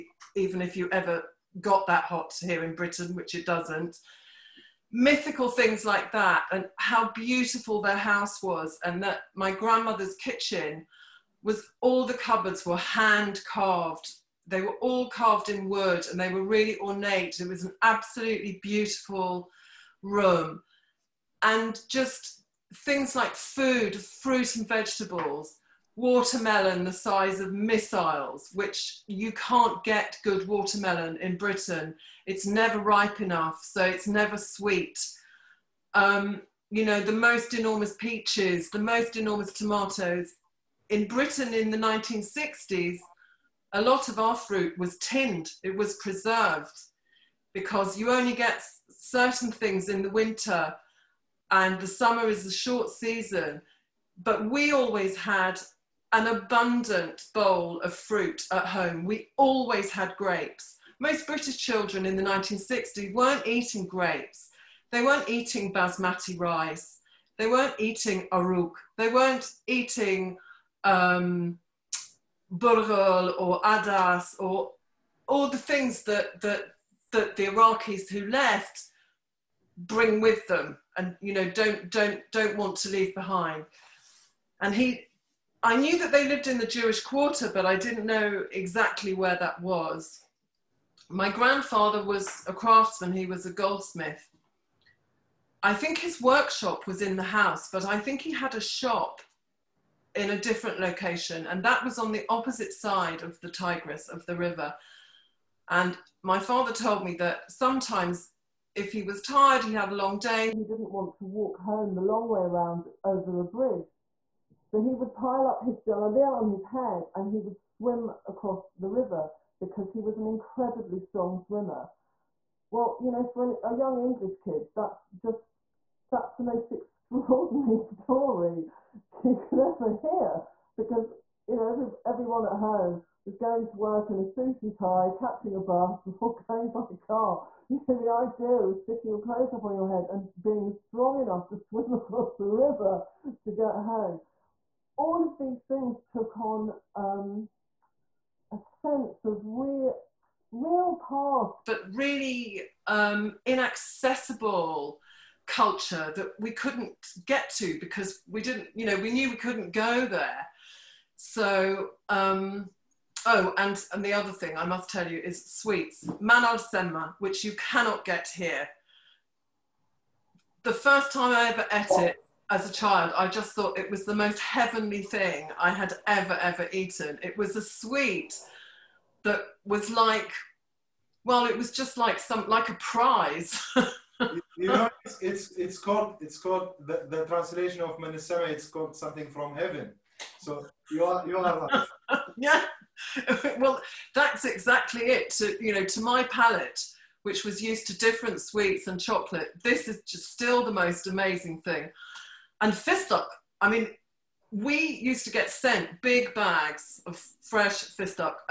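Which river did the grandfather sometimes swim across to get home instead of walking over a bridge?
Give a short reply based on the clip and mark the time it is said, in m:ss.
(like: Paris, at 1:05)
Tigris, at 1:43.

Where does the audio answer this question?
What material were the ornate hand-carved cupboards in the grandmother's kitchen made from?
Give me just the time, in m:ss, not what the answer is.
0:15.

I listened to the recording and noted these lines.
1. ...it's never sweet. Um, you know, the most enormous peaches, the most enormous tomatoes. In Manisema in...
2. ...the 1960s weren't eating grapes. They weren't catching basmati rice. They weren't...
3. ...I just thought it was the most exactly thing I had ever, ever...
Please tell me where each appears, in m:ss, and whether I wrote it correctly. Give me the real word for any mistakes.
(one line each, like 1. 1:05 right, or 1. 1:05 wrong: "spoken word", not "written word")
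1. 0:33 wrong: "Britain", not "Manisema"
2. 1:02 wrong: "eating", not "catching"
3. 2:53 wrong: "heavenly", not "exactly".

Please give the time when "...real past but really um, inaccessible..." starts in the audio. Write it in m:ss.
2:30.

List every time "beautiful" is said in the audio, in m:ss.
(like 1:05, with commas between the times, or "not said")
0:07, 0:18.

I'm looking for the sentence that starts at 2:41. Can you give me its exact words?
So, um, oh, and, and the other thing I must tell you is sweets, manal senma, semma, which you cannot get here.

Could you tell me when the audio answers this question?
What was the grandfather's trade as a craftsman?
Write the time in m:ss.
1:33.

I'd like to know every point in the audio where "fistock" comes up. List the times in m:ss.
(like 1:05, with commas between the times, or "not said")
3:22, 3:27.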